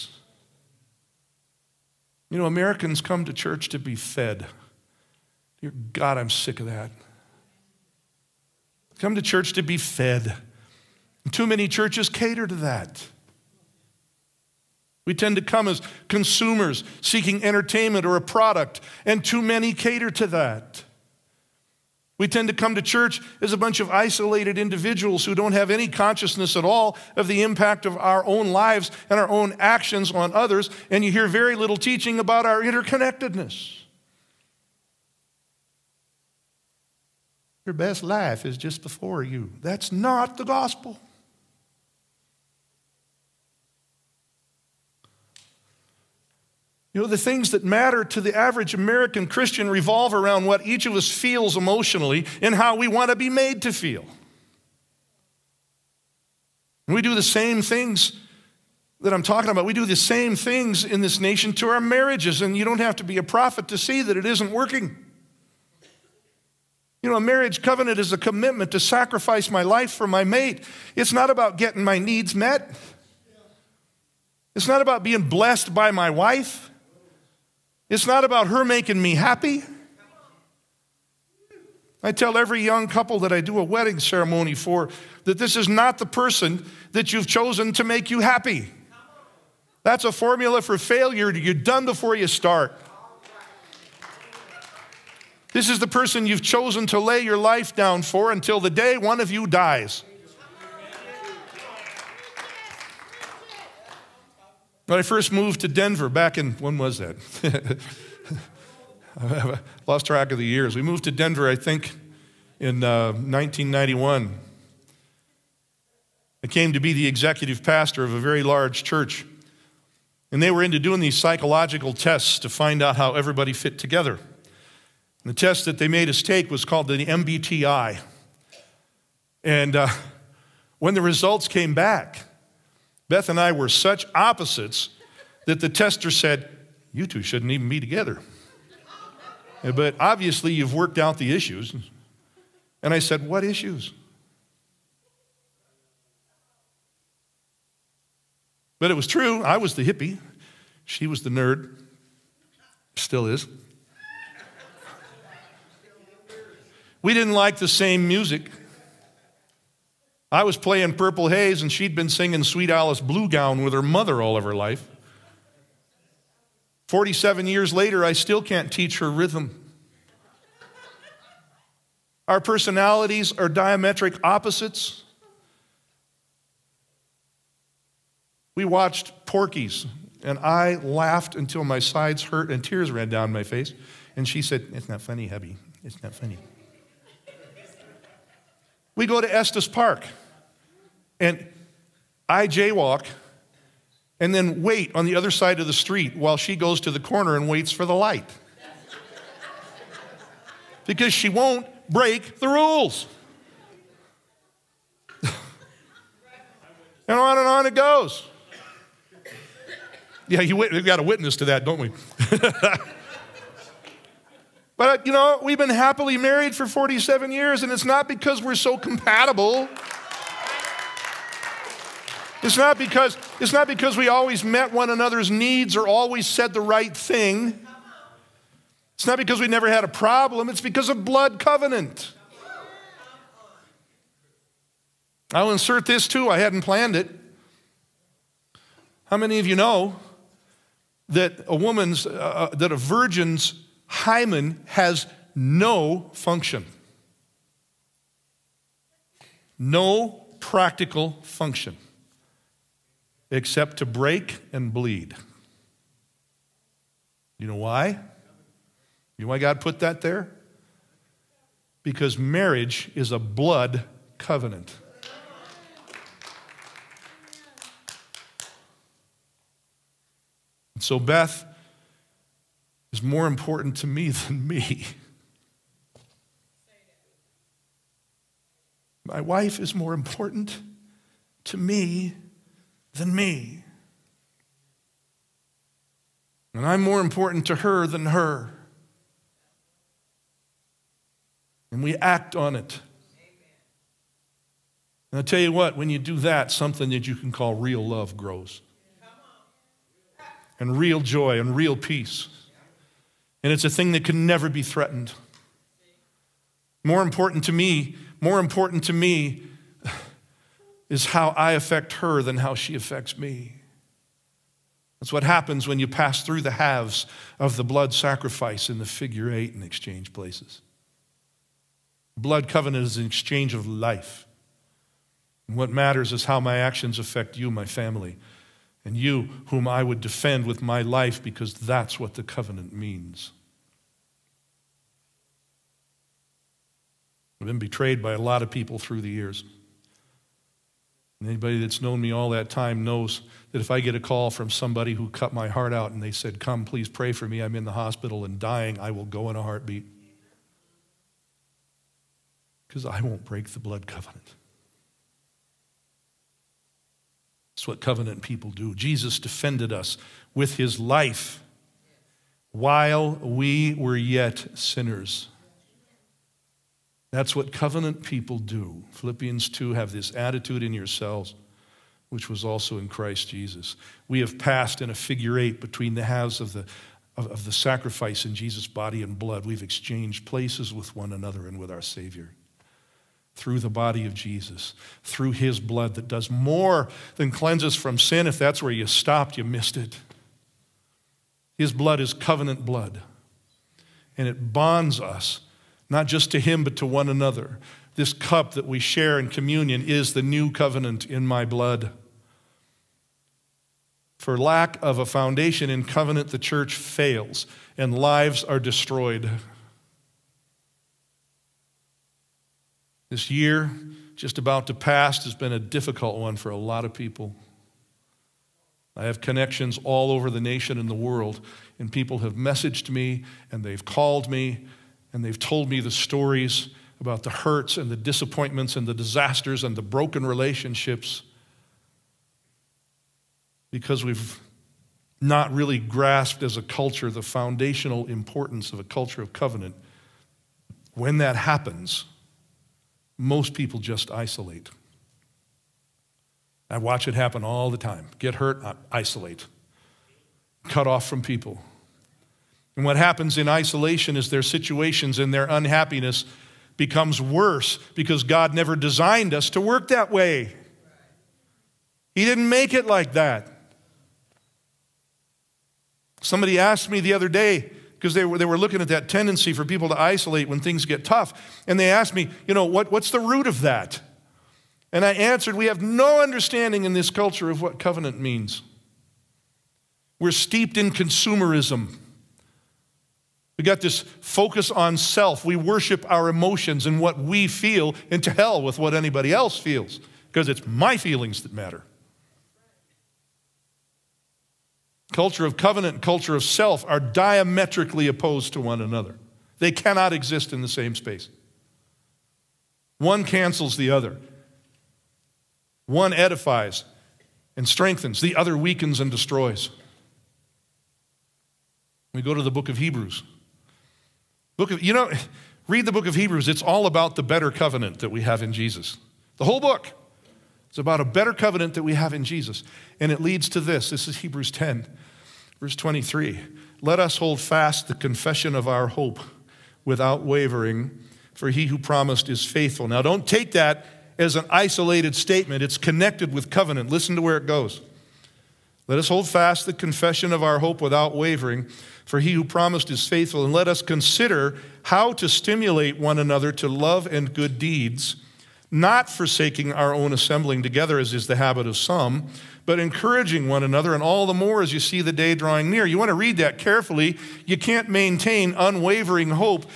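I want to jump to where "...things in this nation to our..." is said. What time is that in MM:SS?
01:00.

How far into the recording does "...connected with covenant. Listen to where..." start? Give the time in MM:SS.
08:55.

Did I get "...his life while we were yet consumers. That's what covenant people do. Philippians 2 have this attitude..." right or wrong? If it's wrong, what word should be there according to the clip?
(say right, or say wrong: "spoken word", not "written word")
wrong: "sinners", not "consumers".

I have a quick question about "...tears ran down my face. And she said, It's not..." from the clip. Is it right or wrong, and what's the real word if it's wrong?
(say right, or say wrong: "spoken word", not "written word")
right.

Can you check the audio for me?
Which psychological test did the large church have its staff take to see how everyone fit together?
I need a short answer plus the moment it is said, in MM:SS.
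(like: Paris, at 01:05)
MBTI, at 02:07.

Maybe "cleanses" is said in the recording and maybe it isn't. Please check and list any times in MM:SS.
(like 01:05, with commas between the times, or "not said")
06:27.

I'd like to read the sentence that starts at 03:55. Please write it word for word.
I'll insert this too, I hadn't planned it.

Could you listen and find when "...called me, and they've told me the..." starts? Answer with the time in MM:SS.
07:03.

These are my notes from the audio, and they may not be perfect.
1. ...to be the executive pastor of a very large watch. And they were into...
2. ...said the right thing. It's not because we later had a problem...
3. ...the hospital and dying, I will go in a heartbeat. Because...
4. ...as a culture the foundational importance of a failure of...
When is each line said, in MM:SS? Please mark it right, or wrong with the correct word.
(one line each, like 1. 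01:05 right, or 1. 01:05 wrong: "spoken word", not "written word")
1. 01:56 wrong: "church", not "watch"
2. 03:46 wrong: "never", not "later"
3. 05:47 right
4. 07:16 wrong: "culture", not "failure".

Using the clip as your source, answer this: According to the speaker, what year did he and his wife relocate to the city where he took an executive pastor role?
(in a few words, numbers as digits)
1991.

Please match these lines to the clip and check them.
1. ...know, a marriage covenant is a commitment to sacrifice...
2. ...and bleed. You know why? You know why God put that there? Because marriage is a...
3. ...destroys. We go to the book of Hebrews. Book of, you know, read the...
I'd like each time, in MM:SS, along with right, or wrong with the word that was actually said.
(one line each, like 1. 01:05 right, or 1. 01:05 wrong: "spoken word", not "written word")
1. 01:07 right
2. 04:14 right
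3. 08:29 right.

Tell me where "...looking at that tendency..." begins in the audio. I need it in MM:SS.
07:48.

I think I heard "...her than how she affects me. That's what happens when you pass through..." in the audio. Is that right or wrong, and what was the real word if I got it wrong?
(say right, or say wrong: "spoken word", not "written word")
right.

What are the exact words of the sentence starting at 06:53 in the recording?
This year, just about to pass, has been a difficult one for a lot of people.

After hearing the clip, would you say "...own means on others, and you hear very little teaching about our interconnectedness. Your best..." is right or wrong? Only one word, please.
wrong.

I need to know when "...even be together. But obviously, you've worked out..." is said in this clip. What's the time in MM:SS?
02:17.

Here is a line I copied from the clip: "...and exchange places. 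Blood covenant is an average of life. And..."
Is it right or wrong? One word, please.
wrong.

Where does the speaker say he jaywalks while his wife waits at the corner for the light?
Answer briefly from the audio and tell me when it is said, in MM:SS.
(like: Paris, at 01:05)
Estes Park, at 03:09.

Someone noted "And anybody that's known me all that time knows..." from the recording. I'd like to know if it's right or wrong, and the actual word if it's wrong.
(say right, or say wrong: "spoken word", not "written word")
right.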